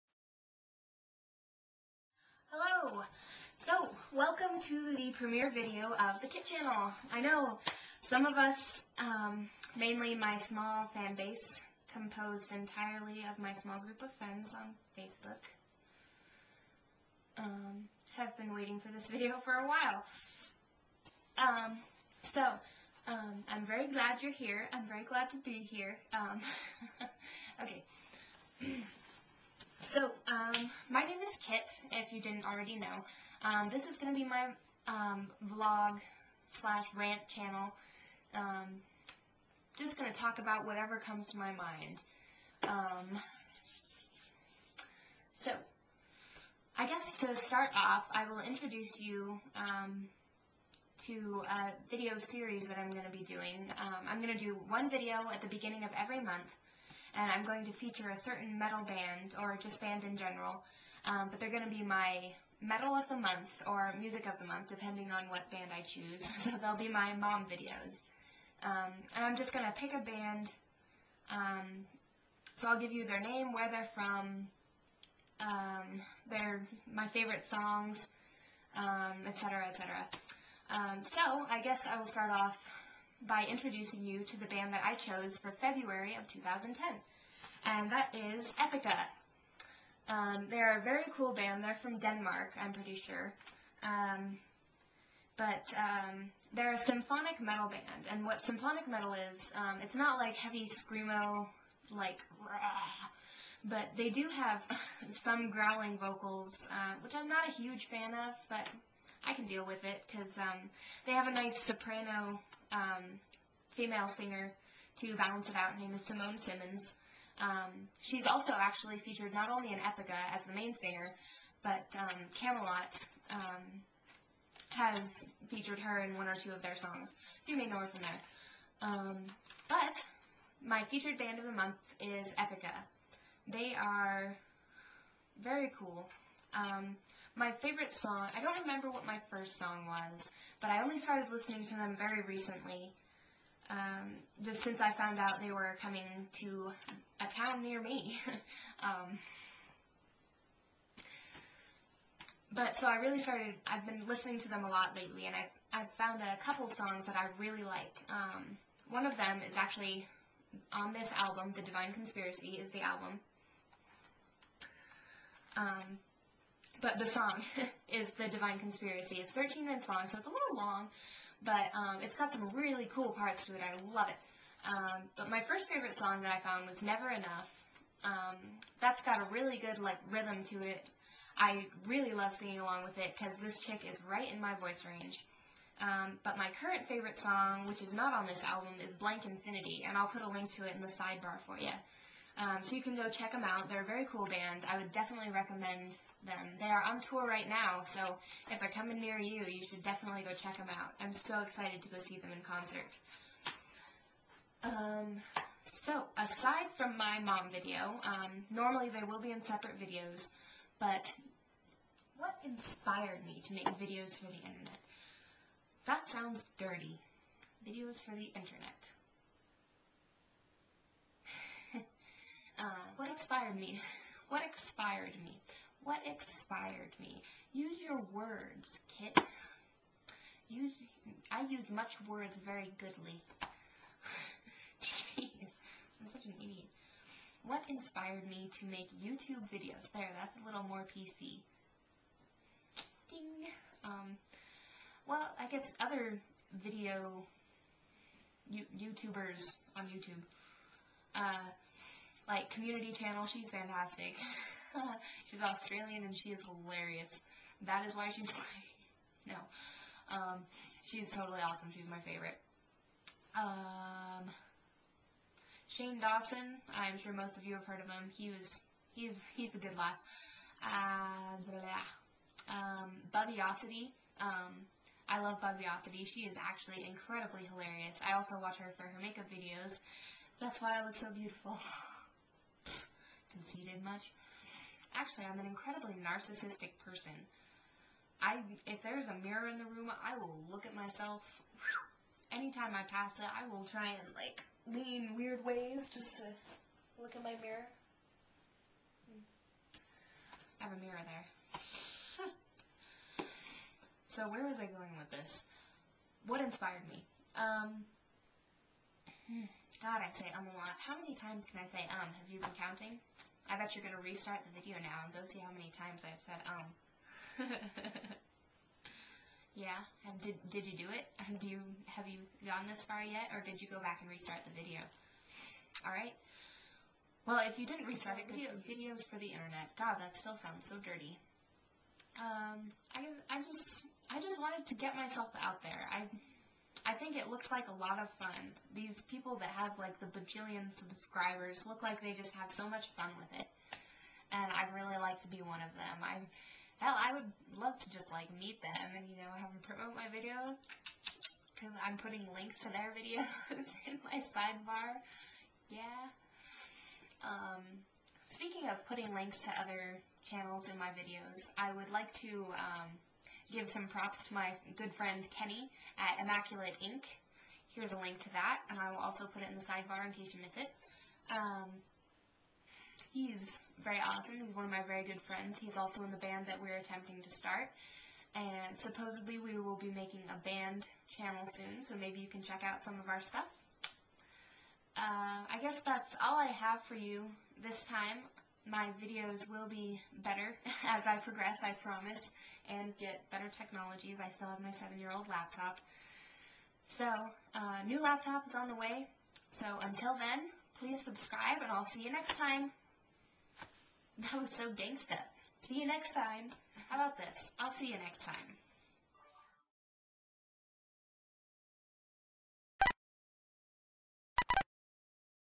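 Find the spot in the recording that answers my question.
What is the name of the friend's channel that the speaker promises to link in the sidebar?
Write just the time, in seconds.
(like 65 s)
366 s.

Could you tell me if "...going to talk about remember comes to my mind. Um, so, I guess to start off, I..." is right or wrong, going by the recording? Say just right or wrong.
wrong.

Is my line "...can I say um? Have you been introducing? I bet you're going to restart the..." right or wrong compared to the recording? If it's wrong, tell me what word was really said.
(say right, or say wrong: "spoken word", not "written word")
wrong: "counting", not "introducing".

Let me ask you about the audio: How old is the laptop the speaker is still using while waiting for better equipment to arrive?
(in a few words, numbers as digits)
7 years.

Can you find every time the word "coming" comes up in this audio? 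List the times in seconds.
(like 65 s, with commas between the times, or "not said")
145 s, 198 s.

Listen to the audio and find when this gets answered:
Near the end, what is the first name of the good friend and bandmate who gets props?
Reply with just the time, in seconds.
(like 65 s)
365 s.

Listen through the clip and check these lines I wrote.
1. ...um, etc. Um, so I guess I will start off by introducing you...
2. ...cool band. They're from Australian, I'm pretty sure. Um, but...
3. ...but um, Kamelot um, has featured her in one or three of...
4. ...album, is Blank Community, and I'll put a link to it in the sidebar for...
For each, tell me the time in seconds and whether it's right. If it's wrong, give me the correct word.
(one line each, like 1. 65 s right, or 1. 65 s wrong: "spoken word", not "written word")
1. 79 s right
2. 91 s wrong: "Denmark", not "Australian"
3. 121 s wrong: "two", not "three"
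4. 188 s wrong: "Infinity", not "Community".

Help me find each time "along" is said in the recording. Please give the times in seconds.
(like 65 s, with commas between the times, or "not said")
182 s.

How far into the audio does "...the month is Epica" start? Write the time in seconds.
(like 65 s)
131 s.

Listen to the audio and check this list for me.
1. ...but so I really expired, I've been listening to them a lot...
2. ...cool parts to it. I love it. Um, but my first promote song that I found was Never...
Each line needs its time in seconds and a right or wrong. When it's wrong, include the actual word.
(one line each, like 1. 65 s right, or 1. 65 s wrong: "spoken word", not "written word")
1. 152 s wrong: "started", not "expired"
2. 172 s wrong: "favorite", not "promote".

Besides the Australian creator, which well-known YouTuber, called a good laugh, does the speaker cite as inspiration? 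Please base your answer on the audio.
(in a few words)
Shane Dawson.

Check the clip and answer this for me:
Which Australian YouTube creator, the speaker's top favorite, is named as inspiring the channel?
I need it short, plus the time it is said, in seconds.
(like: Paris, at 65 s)
Community Channel, at 252 s.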